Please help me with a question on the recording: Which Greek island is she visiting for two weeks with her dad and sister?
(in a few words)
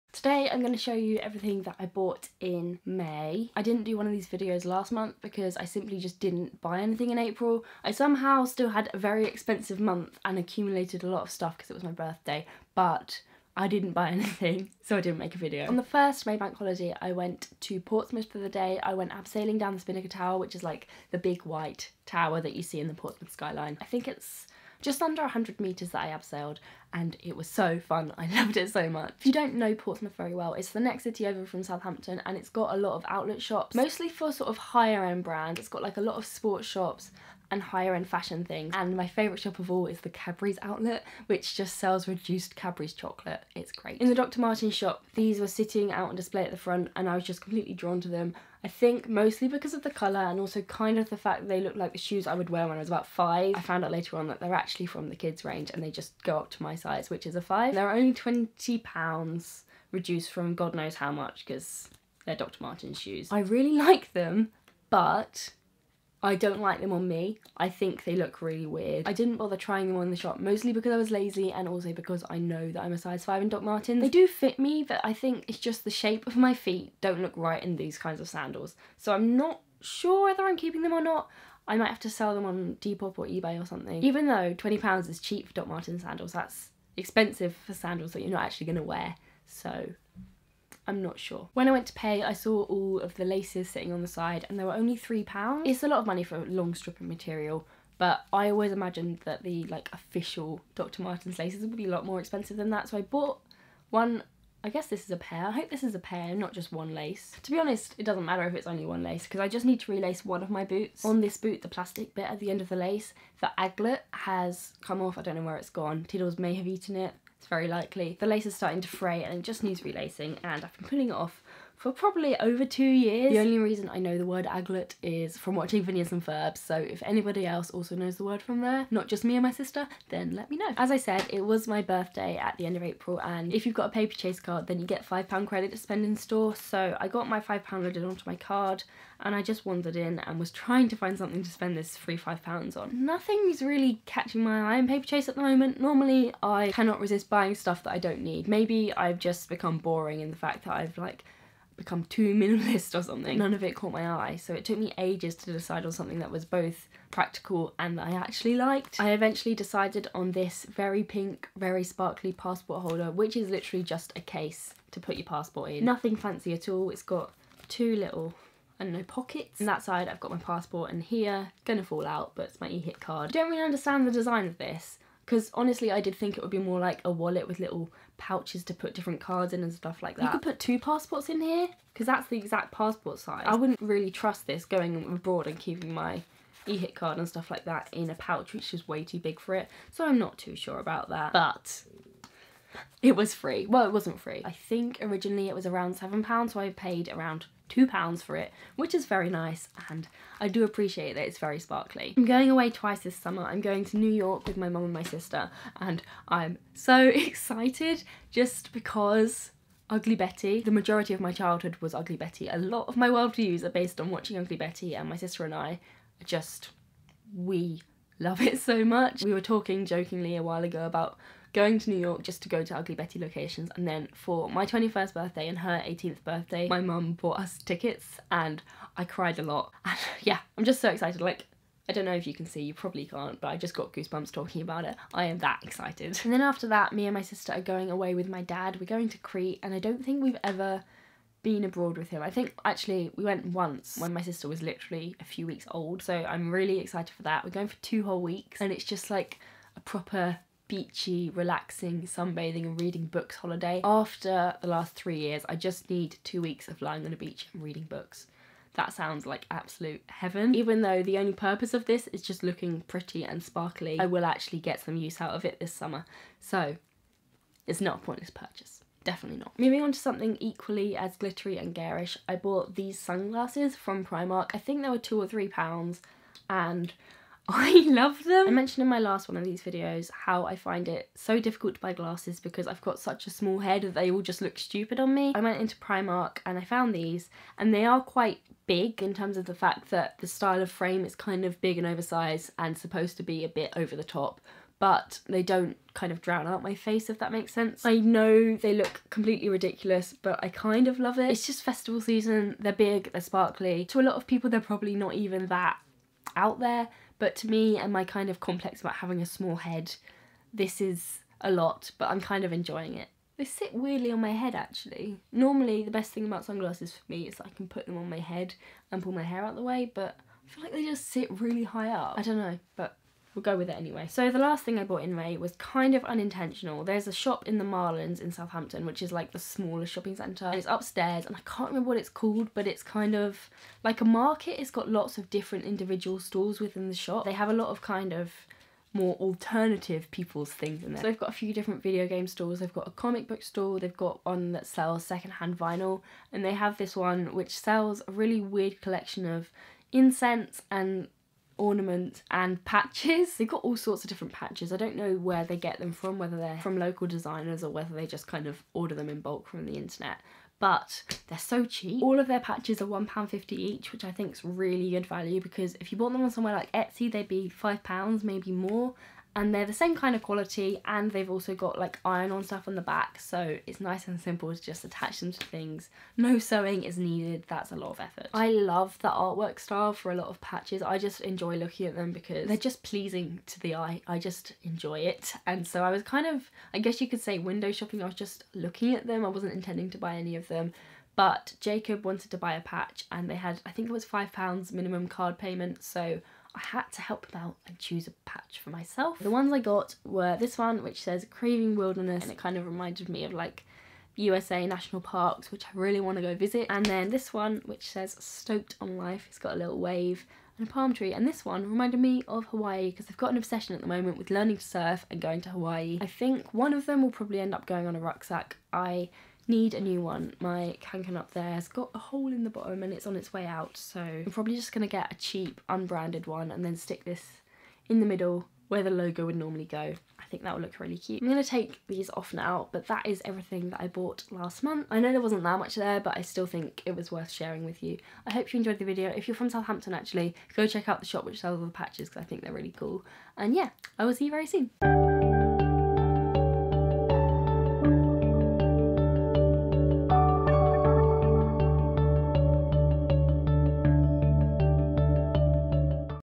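Crete.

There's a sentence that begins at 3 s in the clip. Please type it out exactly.
I didn't do one of these videos last month because I simply just didn't buy anything in April.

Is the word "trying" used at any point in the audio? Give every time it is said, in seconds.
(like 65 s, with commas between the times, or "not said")
69 s, 140 s.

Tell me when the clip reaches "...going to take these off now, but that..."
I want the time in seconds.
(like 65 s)
431 s.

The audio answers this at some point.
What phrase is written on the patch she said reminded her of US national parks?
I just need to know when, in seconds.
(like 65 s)
401 s.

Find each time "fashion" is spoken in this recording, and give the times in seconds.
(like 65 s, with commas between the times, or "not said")
38 s.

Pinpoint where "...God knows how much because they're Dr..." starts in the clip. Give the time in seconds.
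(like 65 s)
60 s.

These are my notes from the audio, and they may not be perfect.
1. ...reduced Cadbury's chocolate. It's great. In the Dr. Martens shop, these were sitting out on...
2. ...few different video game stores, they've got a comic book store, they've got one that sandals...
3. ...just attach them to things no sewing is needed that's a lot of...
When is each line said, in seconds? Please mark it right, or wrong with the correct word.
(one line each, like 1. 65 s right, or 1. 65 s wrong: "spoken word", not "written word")
1. 42 s right
2. 341 s wrong: "sells", not "sandals"
3. 374 s right.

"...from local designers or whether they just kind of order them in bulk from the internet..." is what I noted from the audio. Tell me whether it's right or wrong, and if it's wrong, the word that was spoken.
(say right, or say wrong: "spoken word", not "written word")
right.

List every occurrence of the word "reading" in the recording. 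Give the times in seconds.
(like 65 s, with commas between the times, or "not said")
252 s, 257 s.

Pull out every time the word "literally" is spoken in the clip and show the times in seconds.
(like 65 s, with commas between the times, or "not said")
163 s, 244 s.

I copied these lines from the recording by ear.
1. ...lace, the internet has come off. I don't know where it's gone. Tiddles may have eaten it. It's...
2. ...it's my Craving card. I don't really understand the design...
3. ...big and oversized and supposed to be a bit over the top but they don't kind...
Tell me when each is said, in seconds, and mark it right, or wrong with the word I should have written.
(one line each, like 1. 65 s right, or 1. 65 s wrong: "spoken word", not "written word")
1. 112 s wrong: "aglet", not "internet"
2. 172 s wrong: "EHIC", not "Craving"
3. 291 s right.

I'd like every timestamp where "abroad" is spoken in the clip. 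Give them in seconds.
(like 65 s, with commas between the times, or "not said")
185 s, 241 s.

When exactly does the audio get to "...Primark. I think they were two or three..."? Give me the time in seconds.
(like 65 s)
274 s.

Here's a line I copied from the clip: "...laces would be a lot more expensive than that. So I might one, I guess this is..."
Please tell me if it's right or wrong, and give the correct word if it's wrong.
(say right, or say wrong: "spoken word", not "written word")
wrong: "bought", not "might".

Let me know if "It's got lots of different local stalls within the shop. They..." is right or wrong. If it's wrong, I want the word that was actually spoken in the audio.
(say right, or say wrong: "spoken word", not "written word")
wrong: "individual", not "local".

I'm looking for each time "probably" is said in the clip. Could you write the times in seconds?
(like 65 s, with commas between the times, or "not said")
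121 s, 232 s, 304 s, 417 s, 424 s.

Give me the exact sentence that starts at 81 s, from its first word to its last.
I might have to sell them on Depop or eBay or something.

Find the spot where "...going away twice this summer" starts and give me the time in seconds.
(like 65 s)
202 s.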